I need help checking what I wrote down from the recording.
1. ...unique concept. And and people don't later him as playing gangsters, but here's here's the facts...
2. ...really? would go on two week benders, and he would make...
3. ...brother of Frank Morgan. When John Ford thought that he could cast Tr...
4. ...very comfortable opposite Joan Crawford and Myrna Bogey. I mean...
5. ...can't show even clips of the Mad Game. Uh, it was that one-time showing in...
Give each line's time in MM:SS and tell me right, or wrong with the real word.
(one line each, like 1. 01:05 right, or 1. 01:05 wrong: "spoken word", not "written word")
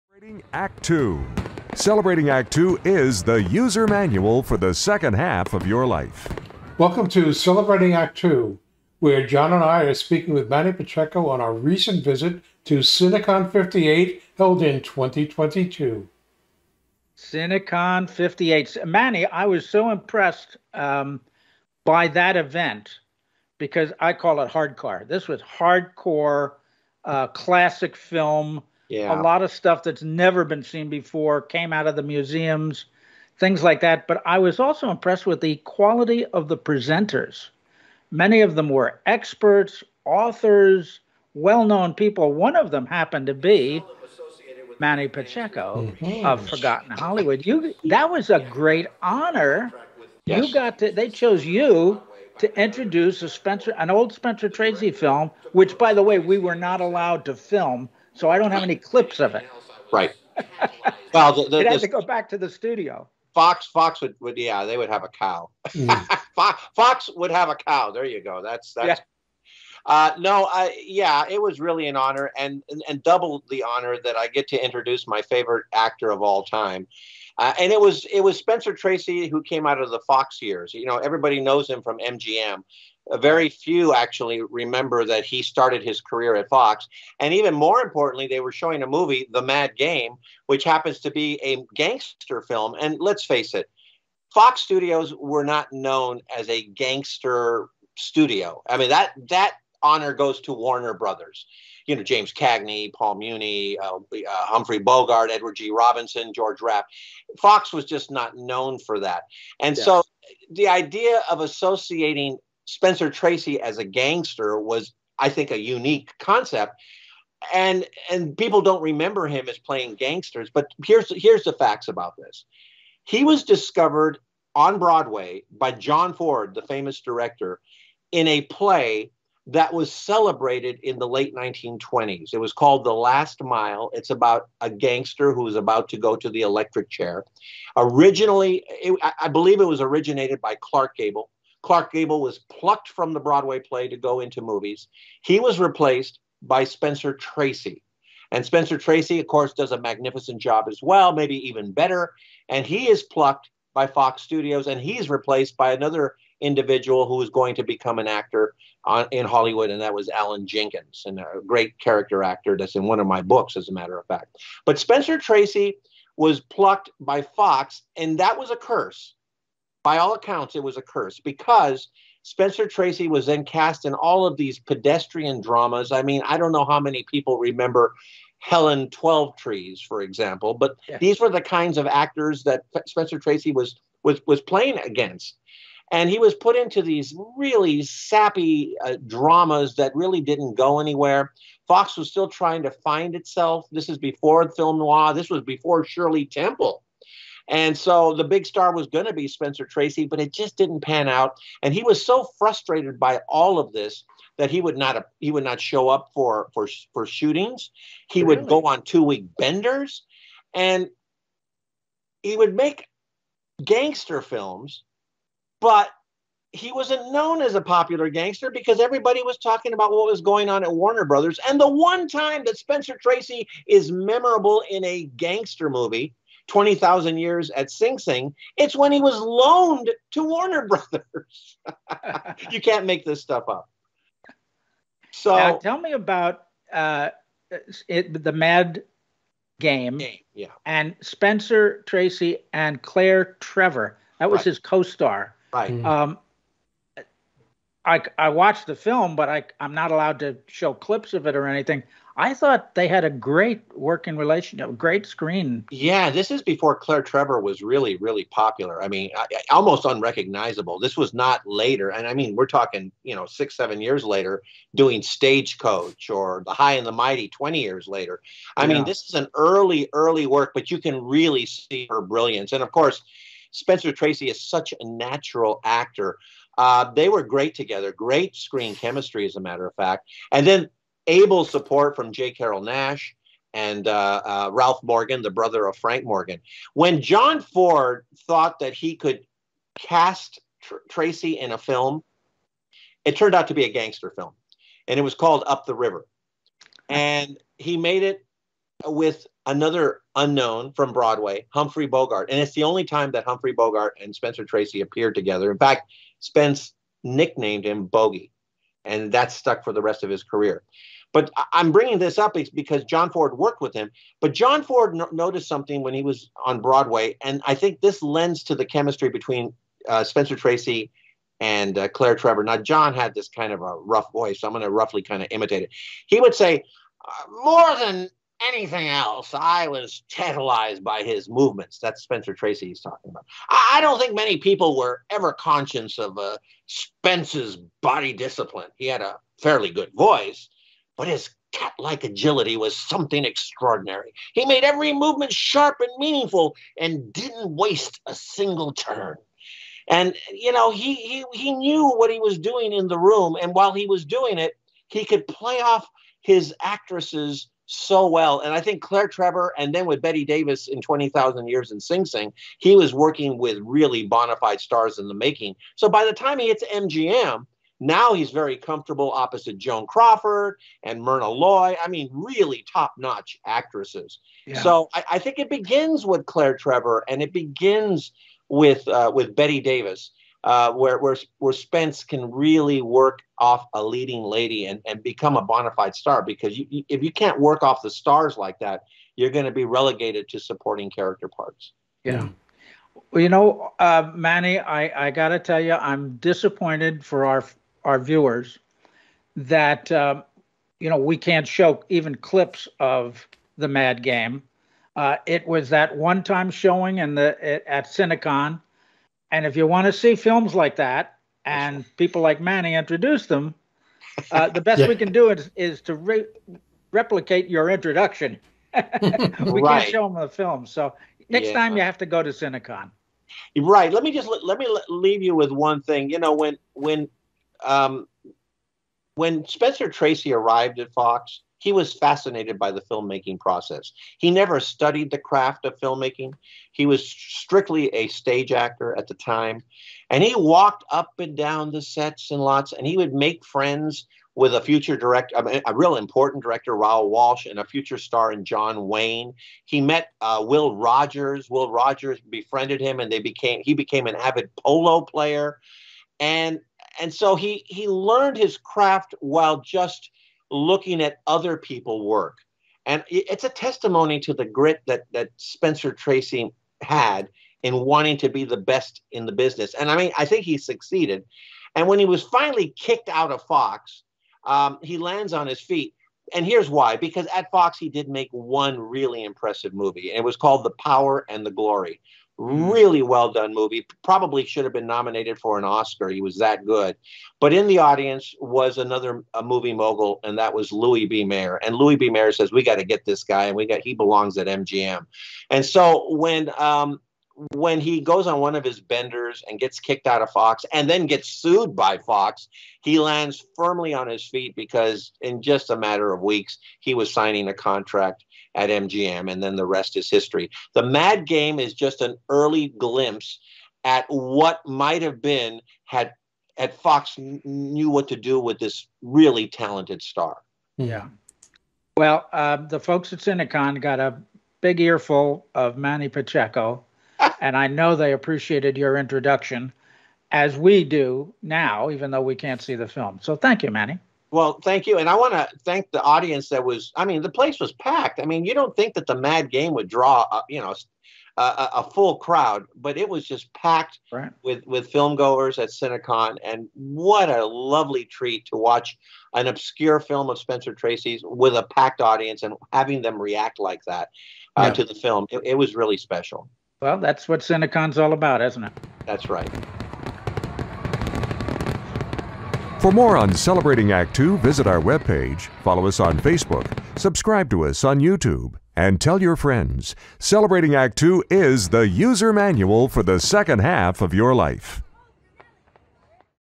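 1. 01:55 wrong: "remember", not "later"
2. 03:28 right
3. 04:45 right
4. 06:08 wrong: "Loy", not "Bogey"
5. 06:41 right.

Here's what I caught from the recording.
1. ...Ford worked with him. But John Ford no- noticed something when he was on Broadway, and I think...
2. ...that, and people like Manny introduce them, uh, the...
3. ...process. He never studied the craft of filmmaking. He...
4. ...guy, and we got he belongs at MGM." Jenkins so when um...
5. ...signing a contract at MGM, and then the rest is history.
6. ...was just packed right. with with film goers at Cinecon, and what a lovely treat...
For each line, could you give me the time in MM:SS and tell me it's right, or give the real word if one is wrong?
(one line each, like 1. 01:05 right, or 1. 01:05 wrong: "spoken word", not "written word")
1. 05:13 right
2. 06:50 right
3. 07:13 right
4. 08:13 wrong: "And", not "Jenkins"
5. 08:27 right
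6. 09:03 right.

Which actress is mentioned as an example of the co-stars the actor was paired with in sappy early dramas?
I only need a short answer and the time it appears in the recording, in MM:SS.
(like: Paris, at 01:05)
Helen Twelvetrees, at 02:58.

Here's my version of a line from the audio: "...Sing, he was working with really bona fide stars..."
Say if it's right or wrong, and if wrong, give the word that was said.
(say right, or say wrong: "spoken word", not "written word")
right.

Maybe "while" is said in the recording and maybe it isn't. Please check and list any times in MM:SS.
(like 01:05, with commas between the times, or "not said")
05:53, 07:39.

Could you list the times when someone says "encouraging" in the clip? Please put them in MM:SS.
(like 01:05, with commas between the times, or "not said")
not said.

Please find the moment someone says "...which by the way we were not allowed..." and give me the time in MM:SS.
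00:55.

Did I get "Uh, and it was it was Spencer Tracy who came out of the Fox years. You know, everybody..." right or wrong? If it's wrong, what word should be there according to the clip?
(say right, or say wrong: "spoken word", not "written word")
right.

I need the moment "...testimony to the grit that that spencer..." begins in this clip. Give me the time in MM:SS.
07:43.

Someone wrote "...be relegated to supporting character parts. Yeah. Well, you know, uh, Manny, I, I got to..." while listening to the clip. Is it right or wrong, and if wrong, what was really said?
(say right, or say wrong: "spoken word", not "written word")
right.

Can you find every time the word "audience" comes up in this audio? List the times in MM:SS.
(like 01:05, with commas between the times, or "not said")
08:07, 08:56, 09:12.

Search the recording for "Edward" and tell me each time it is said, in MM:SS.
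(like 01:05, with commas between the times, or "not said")
01:45.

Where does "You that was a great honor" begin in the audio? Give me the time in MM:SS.
00:47.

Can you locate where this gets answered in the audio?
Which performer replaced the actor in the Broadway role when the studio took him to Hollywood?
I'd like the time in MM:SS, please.
02:40.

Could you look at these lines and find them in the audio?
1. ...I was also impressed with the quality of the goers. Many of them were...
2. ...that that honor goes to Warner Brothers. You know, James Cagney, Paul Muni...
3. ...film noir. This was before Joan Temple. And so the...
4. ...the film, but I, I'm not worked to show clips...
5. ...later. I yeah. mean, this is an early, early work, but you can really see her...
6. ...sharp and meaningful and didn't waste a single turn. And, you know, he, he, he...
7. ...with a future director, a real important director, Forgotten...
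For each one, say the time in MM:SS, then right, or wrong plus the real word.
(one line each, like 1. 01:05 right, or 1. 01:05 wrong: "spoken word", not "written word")
1. 00:34 wrong: "presenters", not "goers"
2. 01:38 right
3. 03:14 wrong: "Shirley", not "Joan"
4. 04:08 wrong: "allowed", not "worked"
5. 04:27 right
6. 05:45 right
7. 07:24 wrong: "Raoul", not "Forgotten".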